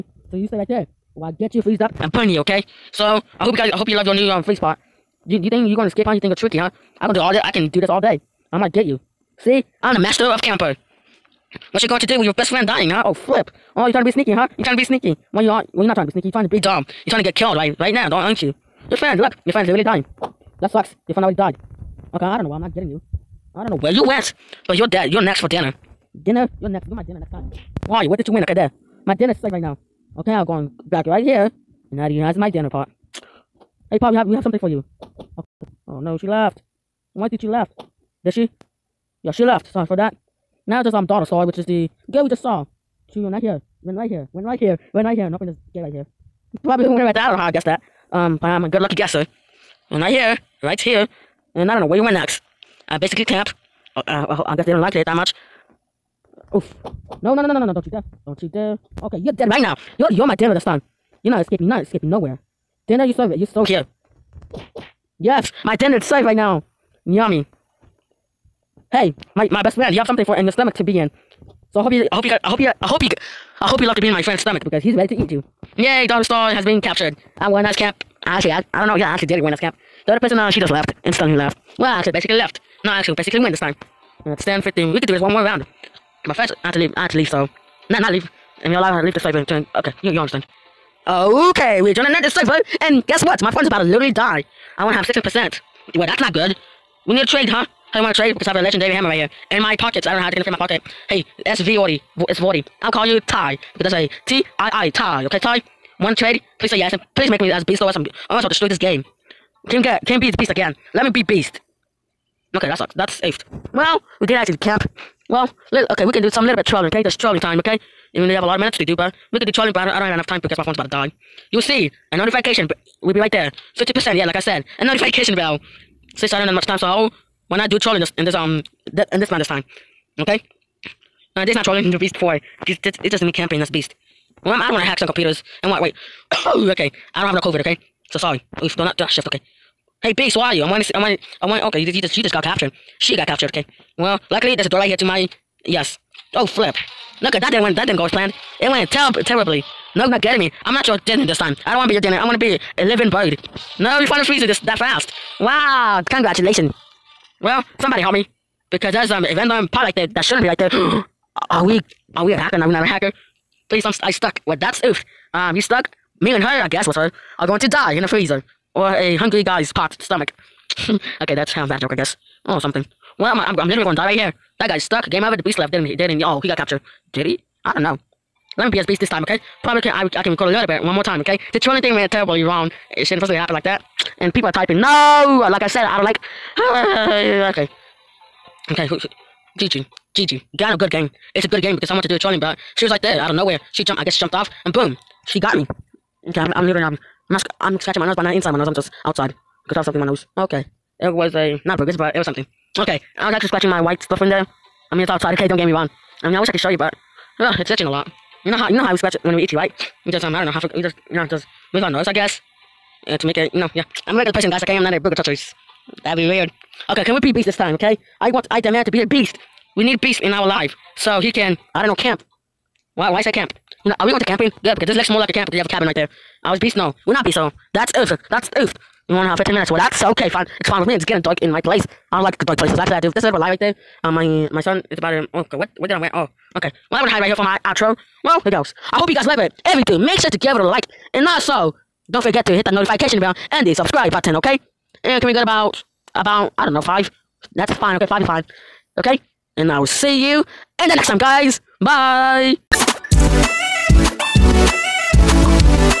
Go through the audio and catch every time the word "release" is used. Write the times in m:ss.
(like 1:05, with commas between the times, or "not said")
not said.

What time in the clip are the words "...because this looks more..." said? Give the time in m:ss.
3:44.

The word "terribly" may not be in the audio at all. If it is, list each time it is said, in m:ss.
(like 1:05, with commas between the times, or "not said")
2:29, 3:02.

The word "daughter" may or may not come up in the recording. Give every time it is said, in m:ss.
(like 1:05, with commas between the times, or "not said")
0:41, 1:16.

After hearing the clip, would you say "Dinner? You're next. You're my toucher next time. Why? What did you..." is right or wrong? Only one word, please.
wrong.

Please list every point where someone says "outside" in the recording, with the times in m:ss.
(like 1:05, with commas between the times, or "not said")
3:19, 3:25.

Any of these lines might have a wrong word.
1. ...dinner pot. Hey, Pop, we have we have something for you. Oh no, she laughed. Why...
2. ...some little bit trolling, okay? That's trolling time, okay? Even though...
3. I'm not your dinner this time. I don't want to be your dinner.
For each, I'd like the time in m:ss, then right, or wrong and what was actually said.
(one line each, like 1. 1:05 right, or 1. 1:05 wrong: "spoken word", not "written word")
1. 0:32 right
2. 1:56 right
3. 2:30 right.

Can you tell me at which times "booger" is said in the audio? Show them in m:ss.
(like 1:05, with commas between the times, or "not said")
3:34.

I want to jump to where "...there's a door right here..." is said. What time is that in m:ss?
2:24.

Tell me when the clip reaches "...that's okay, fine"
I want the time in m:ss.
3:49.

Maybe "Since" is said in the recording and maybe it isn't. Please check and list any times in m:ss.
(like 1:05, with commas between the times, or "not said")
2:06.